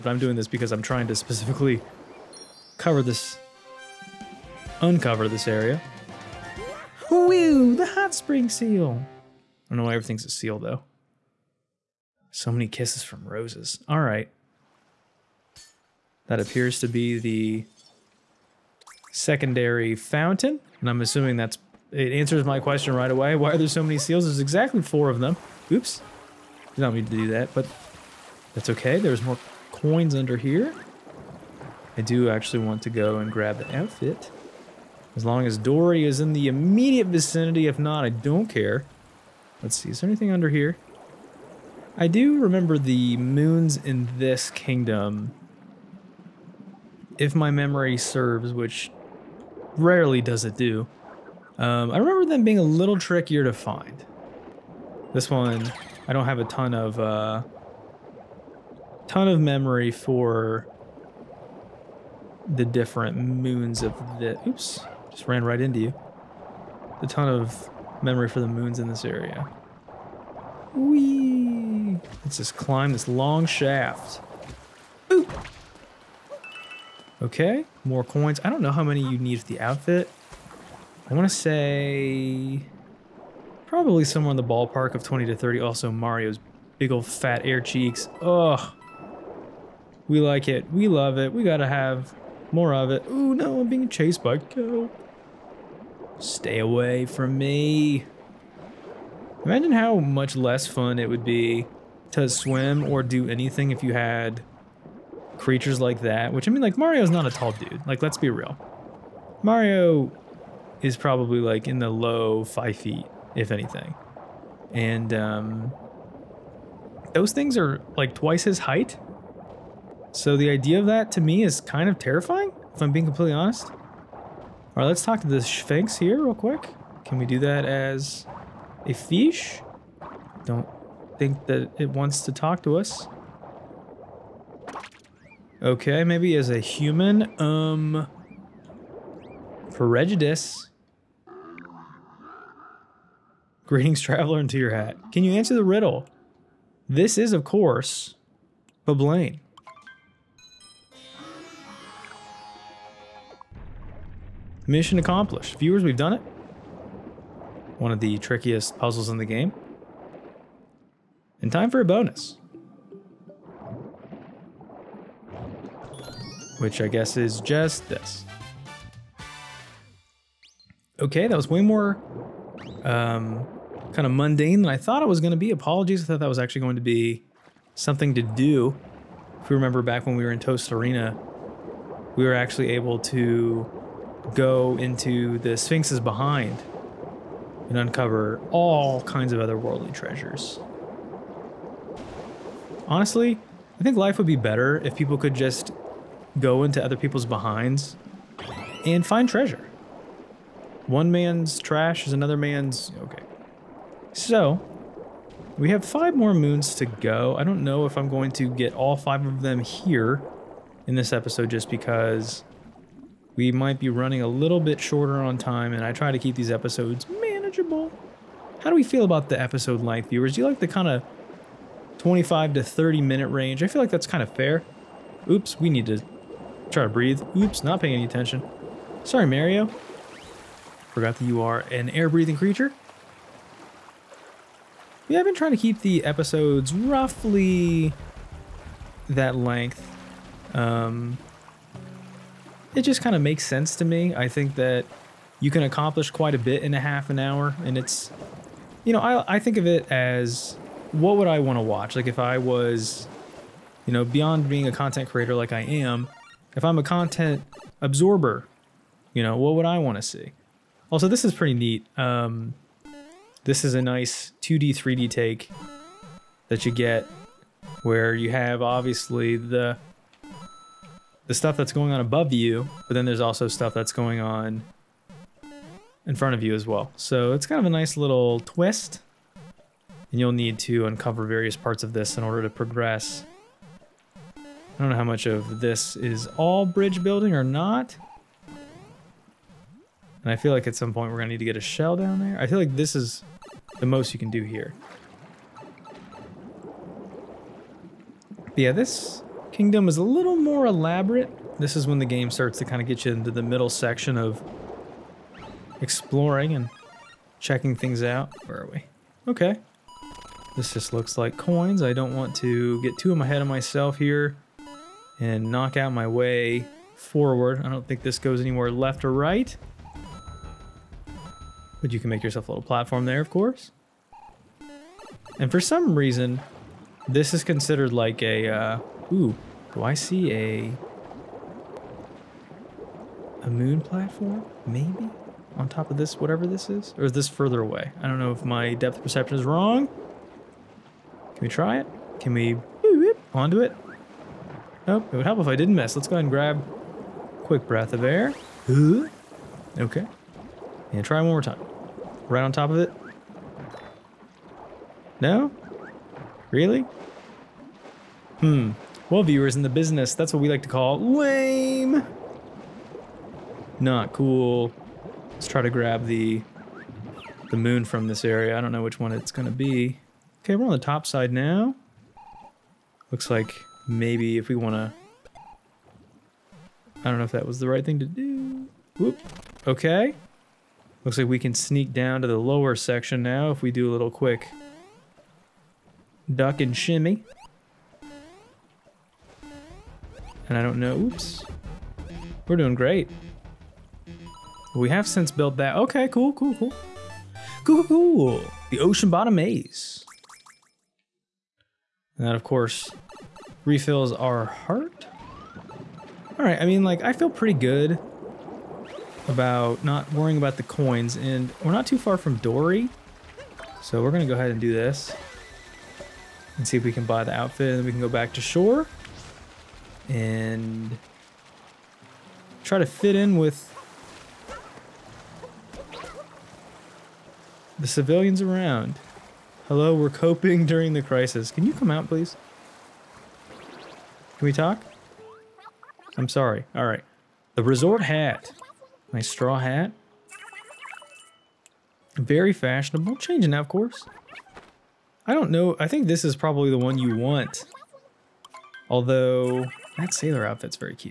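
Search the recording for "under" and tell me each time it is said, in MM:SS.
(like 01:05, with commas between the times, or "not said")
00:30, 00:40.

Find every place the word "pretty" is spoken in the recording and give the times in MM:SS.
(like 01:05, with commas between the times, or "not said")
04:21, 06:47.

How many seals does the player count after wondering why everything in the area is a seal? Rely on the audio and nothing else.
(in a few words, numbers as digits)
4.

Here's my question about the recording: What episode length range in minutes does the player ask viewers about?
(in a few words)
25 to 30 minutes.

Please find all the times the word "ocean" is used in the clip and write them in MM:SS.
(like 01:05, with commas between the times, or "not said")
06:38.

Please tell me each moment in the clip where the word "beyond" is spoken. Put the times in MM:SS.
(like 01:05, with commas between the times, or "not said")
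04:14.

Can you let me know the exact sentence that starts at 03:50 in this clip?
Forgot that you are an air-breathing creature.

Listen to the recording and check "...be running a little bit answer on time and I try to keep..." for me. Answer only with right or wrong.
wrong.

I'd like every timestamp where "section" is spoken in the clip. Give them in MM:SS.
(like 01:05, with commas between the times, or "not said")
05:03, 06:22.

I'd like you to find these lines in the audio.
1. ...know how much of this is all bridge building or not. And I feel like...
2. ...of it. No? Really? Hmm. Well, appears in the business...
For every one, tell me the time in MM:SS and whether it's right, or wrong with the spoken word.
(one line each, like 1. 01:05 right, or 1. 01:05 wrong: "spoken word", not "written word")
1. 04:44 right
2. 05:52 wrong: "viewers", not "appears".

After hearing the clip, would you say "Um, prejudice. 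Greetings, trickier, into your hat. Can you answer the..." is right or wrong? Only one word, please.
wrong.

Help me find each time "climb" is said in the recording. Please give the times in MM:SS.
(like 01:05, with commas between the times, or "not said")
01:12.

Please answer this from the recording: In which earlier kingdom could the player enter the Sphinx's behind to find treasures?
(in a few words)
Tostarena.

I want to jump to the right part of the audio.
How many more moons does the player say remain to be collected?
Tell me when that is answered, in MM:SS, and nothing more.
03:25.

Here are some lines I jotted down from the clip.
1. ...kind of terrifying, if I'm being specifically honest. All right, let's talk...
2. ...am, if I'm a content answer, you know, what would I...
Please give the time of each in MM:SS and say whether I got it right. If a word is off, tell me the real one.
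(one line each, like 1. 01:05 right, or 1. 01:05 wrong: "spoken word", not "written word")
1. 02:01 wrong: "completely", not "specifically"
2. 04:15 wrong: "absorber", not "answer".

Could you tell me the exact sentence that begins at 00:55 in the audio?
This one, I don't have a ton of uh, ton of memory for the different moons of the.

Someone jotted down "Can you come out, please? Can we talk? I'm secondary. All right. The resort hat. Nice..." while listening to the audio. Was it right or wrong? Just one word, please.
wrong.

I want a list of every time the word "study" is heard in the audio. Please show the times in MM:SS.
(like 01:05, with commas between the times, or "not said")
not said.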